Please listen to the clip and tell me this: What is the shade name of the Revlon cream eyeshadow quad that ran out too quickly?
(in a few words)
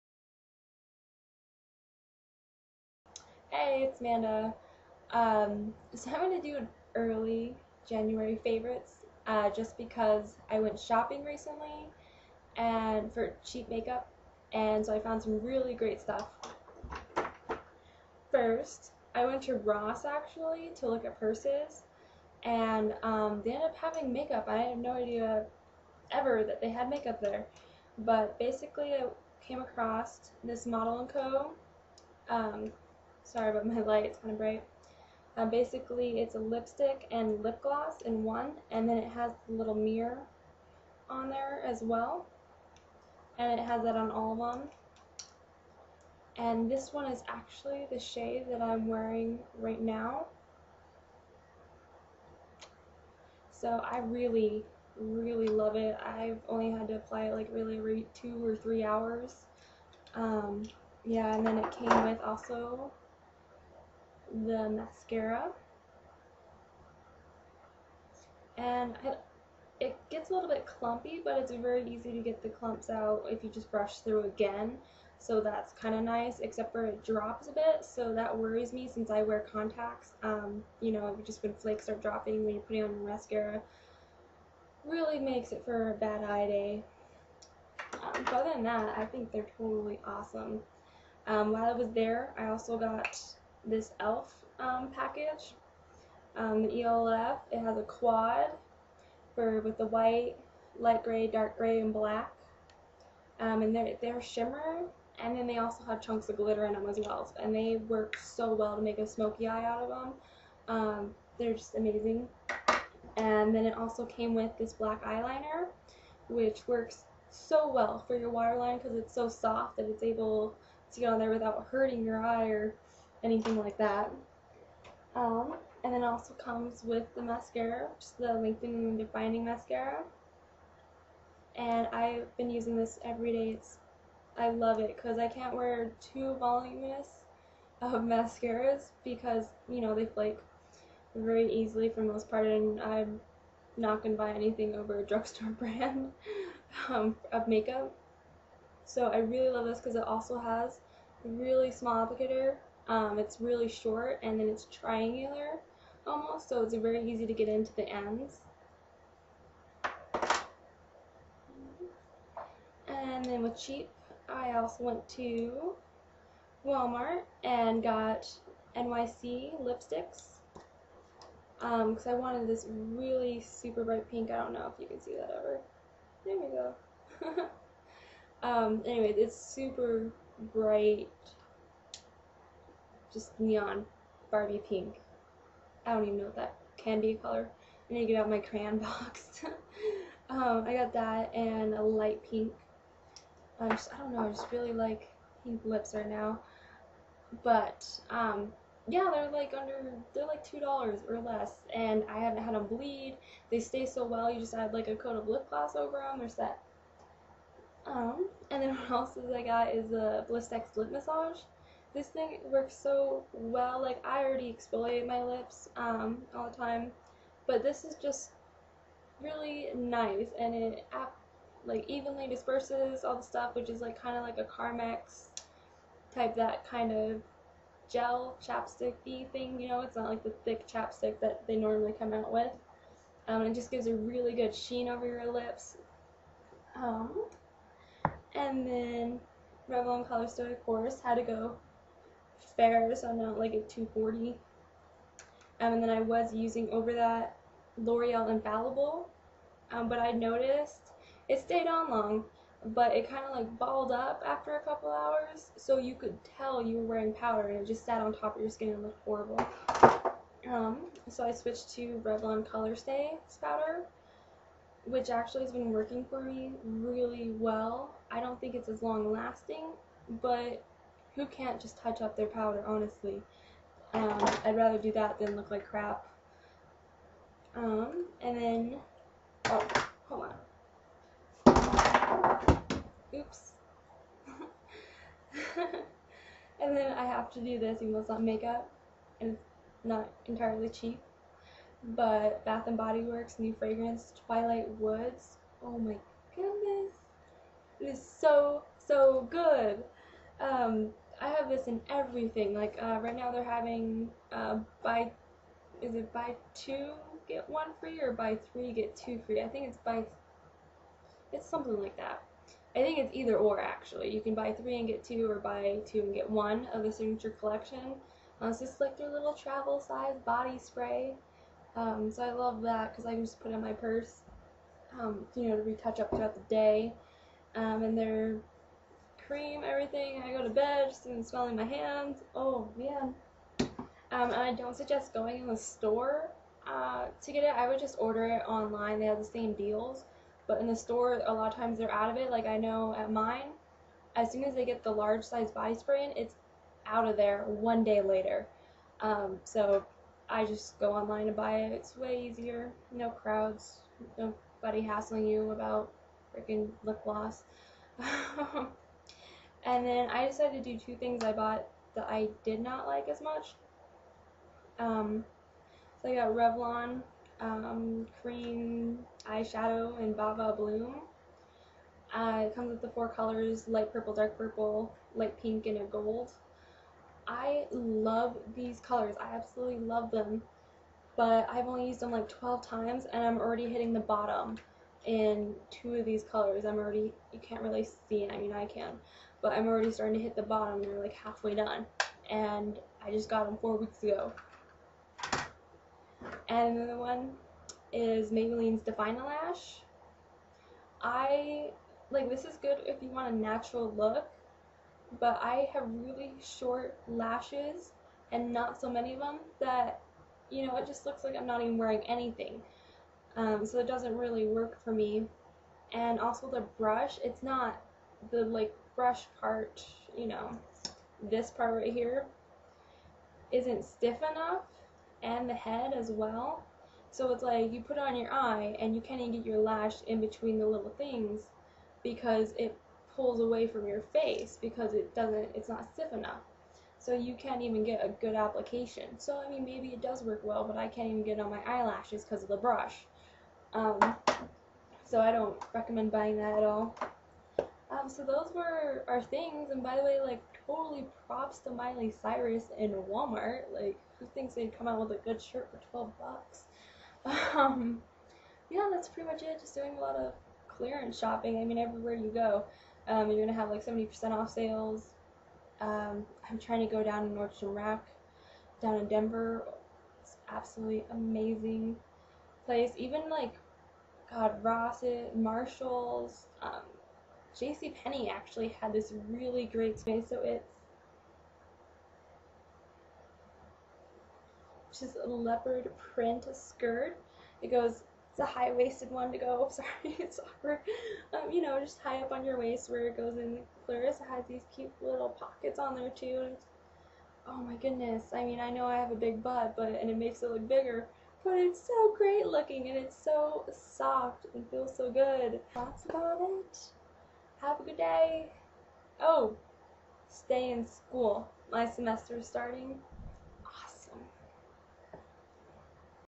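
Va Va Bloom.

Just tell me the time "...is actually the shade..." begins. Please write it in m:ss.
0:47.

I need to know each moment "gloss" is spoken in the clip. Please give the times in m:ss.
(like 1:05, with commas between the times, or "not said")
0:37, 3:25, 5:57.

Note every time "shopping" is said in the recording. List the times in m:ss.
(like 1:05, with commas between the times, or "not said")
0:10, 7:41.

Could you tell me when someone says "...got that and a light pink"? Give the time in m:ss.
3:10.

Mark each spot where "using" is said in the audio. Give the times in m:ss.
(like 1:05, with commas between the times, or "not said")
2:12, 4:06.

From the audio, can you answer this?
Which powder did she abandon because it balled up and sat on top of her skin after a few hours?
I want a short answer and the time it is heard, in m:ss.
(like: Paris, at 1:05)
L'Oreal Infallible, at 4:07.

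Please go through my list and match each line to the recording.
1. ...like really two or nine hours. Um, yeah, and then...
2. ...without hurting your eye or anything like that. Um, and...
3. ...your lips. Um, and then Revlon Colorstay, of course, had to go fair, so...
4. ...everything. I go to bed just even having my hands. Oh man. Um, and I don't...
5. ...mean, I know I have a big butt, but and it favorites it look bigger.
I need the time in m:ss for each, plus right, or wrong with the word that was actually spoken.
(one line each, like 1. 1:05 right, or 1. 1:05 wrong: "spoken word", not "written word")
1. 0:57 wrong: "three", not "nine"
2. 2:01 right
3. 3:55 right
4. 5:29 wrong: "smelling", not "having"
5. 8:18 wrong: "makes", not "favorites".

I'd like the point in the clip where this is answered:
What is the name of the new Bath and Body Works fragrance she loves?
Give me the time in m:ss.
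4:54.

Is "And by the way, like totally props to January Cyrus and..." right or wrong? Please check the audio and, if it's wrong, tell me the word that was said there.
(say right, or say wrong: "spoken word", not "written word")
wrong: "Miley", not "January".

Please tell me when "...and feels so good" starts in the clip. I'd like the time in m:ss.
8:24.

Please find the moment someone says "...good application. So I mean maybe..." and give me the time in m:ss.
7:18.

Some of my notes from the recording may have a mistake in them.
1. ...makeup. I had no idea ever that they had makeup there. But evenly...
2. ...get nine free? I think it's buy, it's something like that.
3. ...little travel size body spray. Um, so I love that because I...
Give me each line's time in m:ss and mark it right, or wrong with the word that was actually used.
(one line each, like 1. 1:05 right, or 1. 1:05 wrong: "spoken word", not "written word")
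1. 0:24 wrong: "basically", not "evenly"
2. 5:08 wrong: "two", not "nine"
3. 5:19 right.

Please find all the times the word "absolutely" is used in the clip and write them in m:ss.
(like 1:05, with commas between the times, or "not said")
6:19, 7:50.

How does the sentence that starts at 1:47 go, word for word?
And they work so well to make a smoky eye out of them.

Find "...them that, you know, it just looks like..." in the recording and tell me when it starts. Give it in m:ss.
6:49.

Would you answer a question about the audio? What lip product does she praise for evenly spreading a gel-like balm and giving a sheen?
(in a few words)
Blistex lip massage.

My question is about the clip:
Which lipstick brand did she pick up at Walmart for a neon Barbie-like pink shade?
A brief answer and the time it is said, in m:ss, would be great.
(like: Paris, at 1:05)
NYC, at 2:48.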